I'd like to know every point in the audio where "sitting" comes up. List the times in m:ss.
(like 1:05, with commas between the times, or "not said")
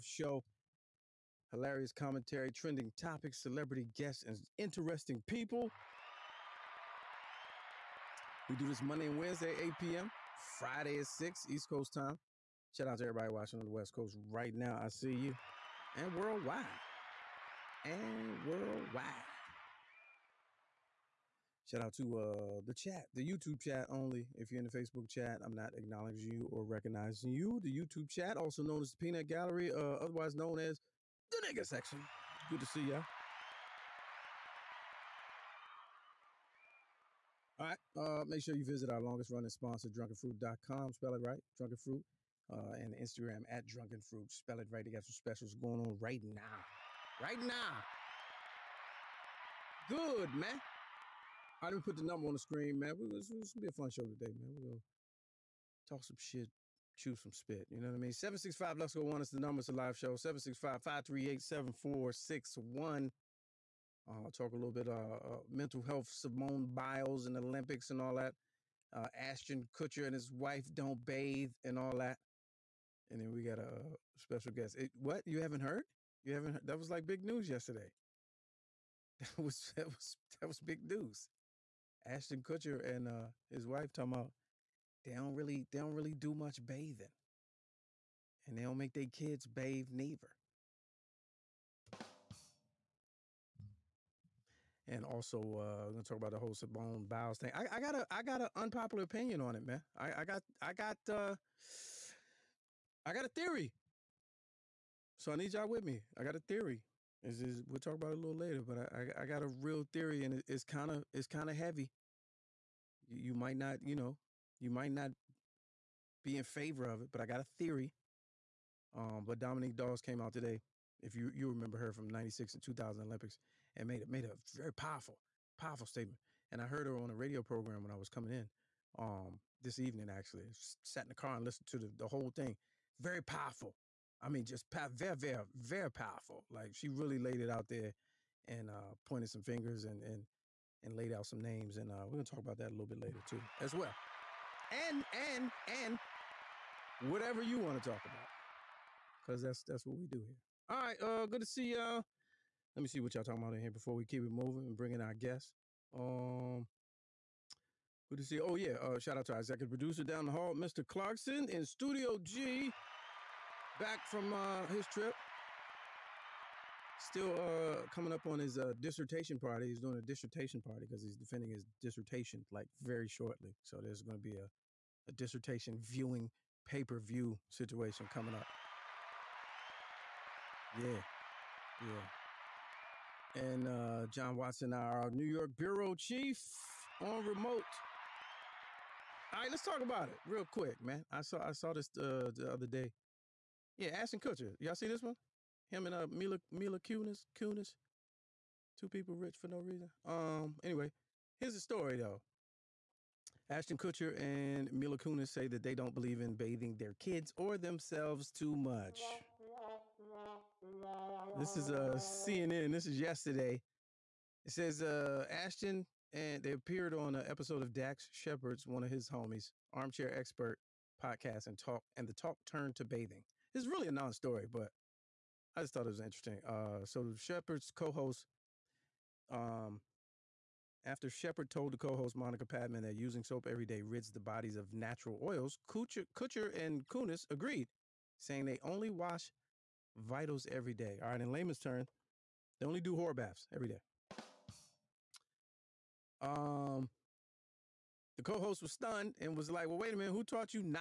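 not said.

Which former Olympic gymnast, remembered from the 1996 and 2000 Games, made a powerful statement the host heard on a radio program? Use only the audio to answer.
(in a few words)
Dominique Dawes.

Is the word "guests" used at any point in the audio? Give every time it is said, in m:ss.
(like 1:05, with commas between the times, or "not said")
0:03, 1:14, 2:35.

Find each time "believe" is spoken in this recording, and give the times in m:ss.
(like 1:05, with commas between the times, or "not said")
3:25.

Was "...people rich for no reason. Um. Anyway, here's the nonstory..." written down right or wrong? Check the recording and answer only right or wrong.
wrong.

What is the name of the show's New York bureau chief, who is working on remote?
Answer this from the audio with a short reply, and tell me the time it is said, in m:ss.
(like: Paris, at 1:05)
John Watson, at 3:04.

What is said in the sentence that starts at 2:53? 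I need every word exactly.
So there's going to be a, a dissertation viewing pay per view situation coming up.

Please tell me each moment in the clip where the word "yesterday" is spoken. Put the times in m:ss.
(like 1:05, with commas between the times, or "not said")
1:17, 3:32.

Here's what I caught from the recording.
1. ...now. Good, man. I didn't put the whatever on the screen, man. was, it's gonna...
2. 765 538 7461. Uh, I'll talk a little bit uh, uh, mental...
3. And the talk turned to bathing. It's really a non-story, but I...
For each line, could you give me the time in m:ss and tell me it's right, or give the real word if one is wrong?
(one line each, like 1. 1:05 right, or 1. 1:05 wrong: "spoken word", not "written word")
1. 0:47 wrong: "number", not "whatever"
2. 1:00 right
3. 3:41 right.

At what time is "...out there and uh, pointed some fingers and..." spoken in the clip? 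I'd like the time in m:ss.
2:17.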